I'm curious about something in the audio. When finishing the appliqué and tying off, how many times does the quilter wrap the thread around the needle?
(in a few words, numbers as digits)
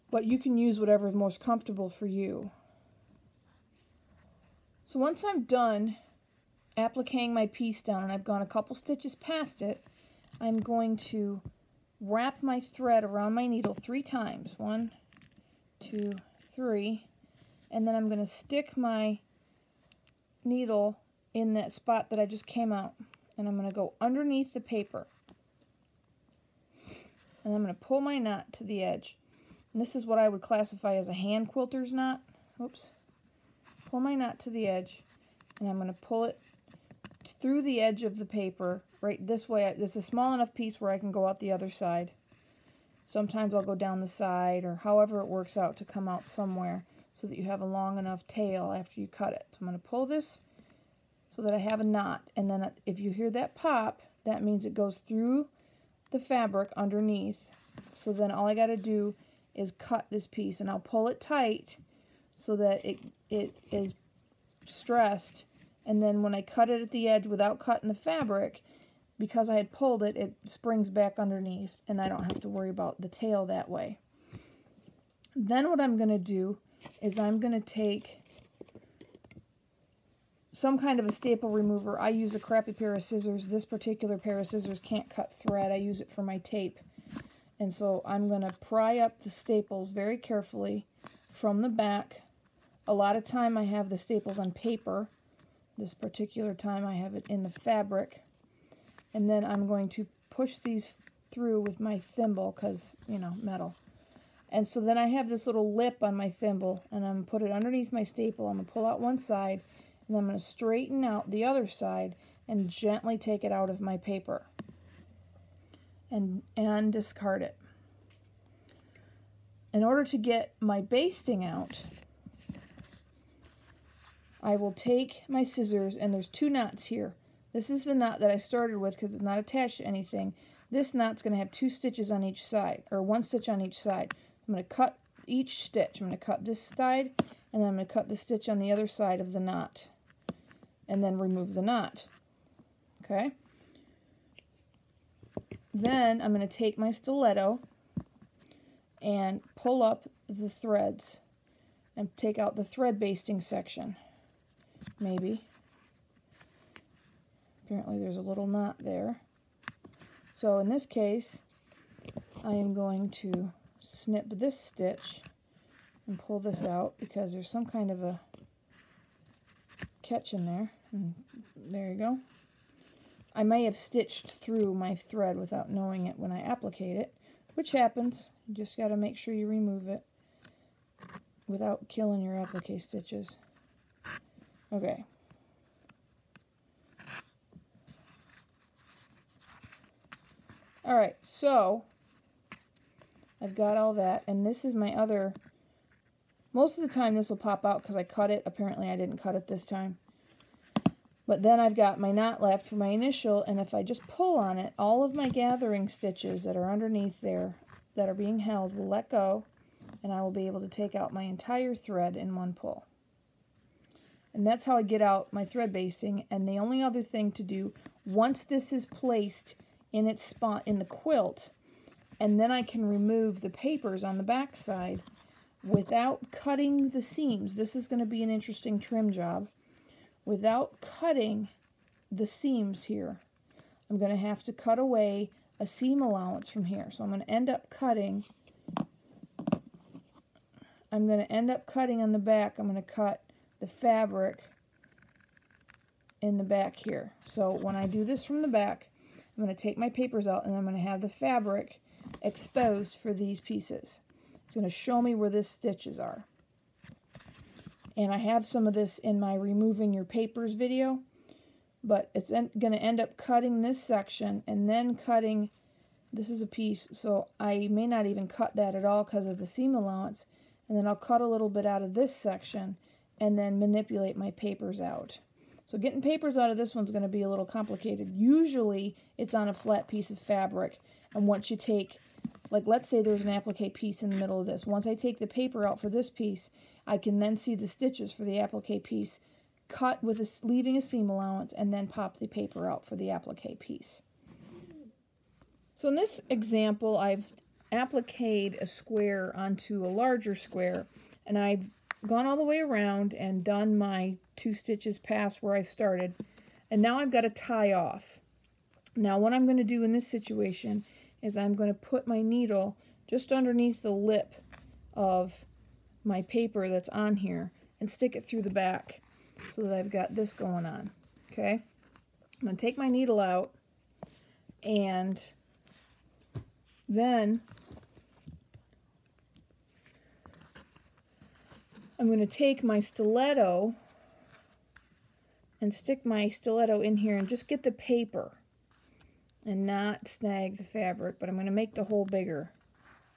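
3.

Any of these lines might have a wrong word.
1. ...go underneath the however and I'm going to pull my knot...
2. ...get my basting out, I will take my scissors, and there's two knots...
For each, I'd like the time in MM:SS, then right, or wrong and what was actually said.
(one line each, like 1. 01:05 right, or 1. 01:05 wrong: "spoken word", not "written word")
1. 00:23 wrong: "paper", not "however"
2. 02:00 right.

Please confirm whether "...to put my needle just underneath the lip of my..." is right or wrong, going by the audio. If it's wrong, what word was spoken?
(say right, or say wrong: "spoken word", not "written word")
right.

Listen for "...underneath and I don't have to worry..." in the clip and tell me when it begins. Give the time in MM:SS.
01:11.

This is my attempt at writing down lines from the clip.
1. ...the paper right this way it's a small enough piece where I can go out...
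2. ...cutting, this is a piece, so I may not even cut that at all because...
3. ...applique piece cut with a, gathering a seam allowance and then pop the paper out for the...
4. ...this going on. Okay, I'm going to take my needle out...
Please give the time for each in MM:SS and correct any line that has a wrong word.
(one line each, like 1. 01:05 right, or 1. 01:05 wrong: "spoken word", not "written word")
1. 00:38 right
2. 04:24 right
3. 04:48 wrong: "leaving", not "gathering"
4. 05:20 right.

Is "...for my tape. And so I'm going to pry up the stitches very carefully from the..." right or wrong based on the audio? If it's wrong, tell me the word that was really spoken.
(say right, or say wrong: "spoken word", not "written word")
wrong: "staples", not "stitches".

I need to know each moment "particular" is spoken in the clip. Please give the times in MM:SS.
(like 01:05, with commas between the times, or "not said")
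01:23, 01:35.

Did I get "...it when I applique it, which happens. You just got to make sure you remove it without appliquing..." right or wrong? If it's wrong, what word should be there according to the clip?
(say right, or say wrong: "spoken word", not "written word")
wrong: "killing", not "appliquing".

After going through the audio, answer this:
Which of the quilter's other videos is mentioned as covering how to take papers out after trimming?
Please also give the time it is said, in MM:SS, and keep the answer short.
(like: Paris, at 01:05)
Removing your papers, at 04:19.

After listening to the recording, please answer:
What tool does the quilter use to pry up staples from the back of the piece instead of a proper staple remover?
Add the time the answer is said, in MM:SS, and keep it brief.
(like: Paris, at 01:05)
A crappy pair of scissors, at 01:22.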